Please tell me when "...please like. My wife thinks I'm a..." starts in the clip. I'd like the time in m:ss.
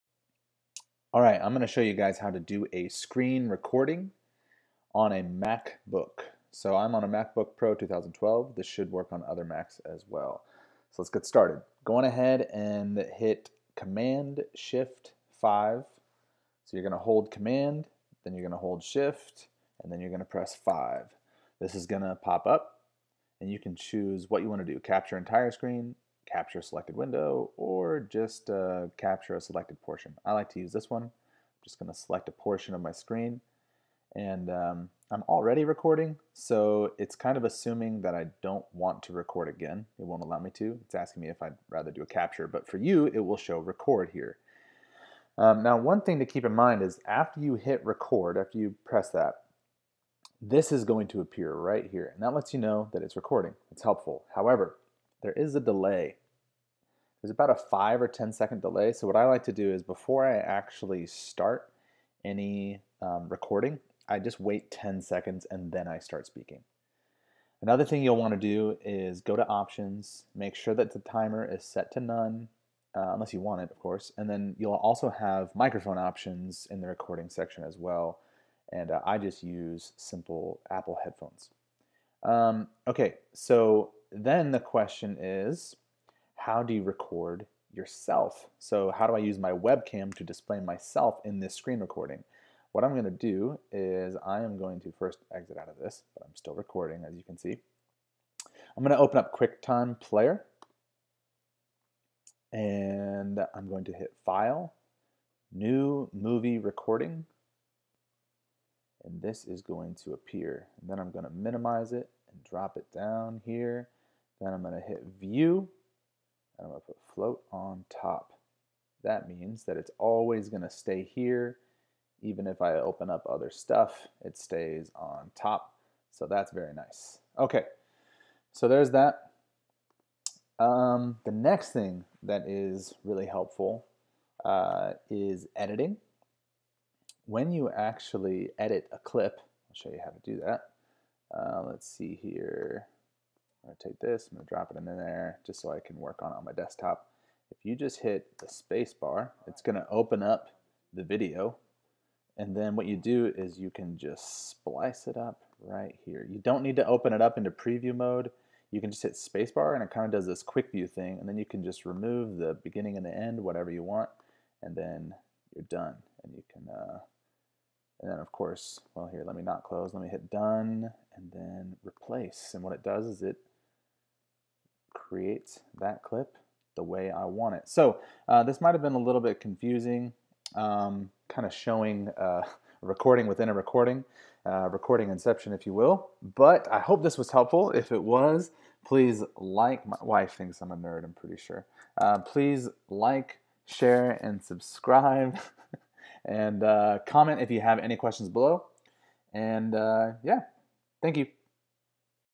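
3:08.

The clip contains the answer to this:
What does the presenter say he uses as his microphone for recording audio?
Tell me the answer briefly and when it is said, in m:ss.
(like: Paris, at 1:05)
Apple headphones, at 1:20.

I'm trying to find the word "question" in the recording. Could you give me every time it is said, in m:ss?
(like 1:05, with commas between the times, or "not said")
1:24, 3:17.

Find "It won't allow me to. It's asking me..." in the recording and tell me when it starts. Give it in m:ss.
0:39.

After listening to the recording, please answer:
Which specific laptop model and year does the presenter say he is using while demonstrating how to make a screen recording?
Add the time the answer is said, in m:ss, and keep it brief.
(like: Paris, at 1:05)
MacBook Pro 2012, at 0:07.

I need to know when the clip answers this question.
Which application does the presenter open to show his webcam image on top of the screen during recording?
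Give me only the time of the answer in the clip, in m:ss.
1:39.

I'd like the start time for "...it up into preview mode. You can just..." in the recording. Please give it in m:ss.
2:37.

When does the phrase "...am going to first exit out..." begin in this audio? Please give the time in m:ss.
1:34.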